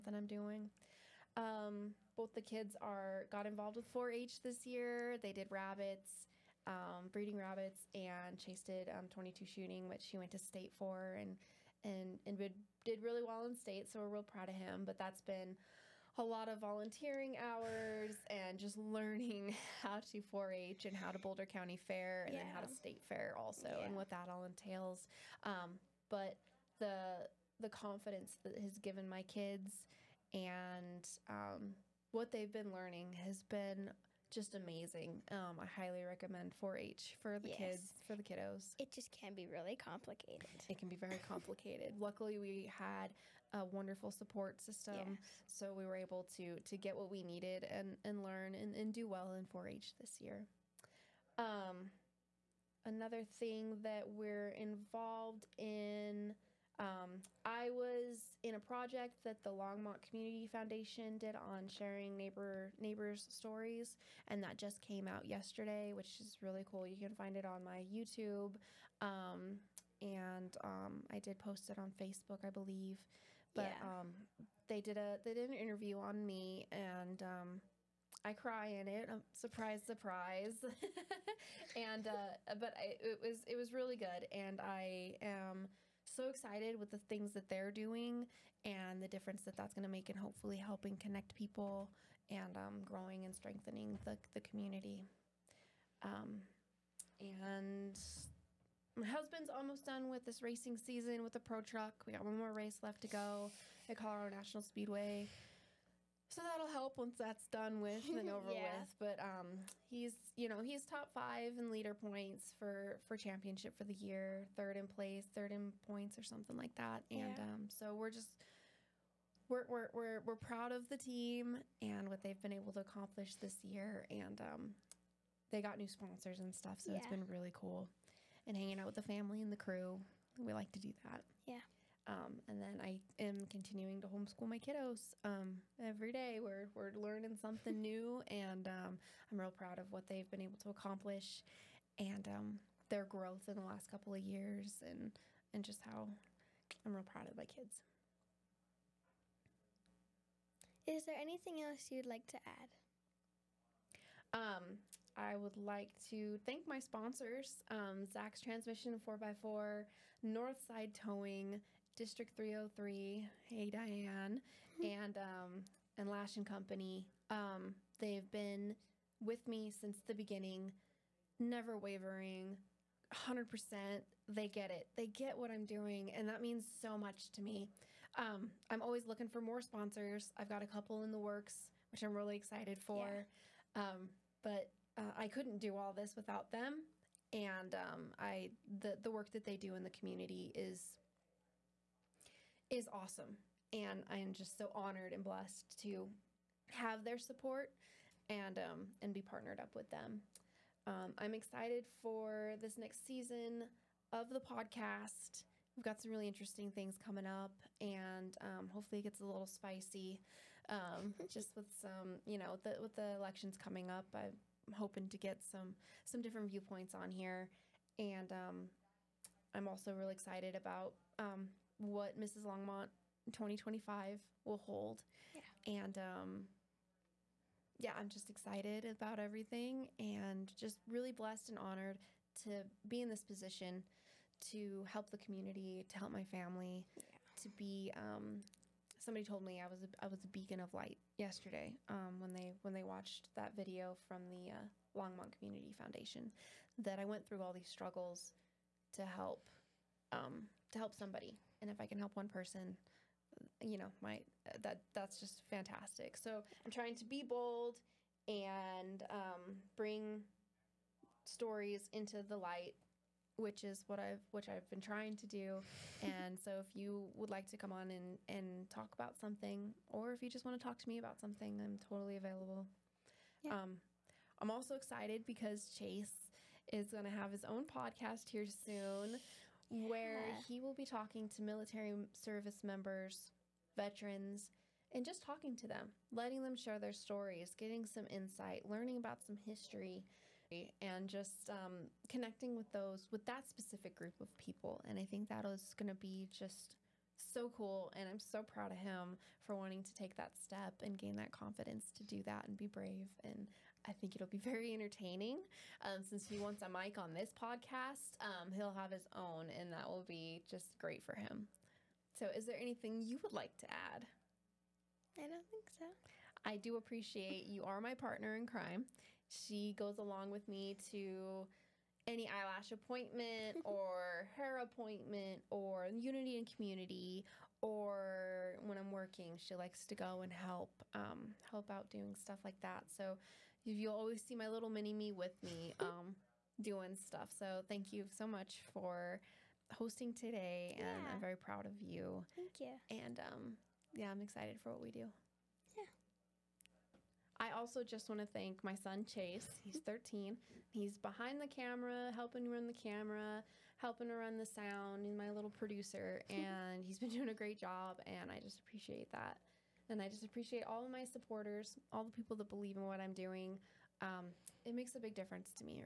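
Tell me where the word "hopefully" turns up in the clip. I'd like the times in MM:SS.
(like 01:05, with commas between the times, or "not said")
01:30, 03:28.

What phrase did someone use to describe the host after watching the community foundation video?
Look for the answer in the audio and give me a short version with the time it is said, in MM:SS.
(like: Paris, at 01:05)
beacon of light, at 04:00.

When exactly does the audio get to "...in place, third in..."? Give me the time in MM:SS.
01:54.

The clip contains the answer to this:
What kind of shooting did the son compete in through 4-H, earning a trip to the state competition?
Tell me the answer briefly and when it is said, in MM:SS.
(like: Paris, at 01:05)
22 shooting, at 00:09.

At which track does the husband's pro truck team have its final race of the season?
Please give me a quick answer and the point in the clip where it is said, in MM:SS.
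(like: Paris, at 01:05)
Colorado National Speedway, at 01:43.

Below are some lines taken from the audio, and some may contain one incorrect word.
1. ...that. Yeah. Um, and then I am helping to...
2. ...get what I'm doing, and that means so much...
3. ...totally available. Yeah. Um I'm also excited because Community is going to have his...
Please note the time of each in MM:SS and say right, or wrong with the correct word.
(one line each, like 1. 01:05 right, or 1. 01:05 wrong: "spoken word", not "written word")
1. 02:11 wrong: "continuing", not "helping"
2. 02:55 right
3. 04:31 wrong: "Chase", not "Community".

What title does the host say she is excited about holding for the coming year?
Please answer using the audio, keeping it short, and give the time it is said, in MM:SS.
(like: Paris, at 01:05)
Mrs. Longmont 2025, at 03:42.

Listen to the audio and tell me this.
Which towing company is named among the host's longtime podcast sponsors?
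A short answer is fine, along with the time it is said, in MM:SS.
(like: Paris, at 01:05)
Northside Towing, at 02:40.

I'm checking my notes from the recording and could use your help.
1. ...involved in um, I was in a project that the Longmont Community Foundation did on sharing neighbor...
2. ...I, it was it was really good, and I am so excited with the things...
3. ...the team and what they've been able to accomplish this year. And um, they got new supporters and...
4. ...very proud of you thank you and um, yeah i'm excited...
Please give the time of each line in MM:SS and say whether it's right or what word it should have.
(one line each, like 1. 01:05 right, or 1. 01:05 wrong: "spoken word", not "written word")
1. 00:54 right
2. 01:22 right
3. 02:00 wrong: "sponsors", not "supporters"
4. 05:41 right.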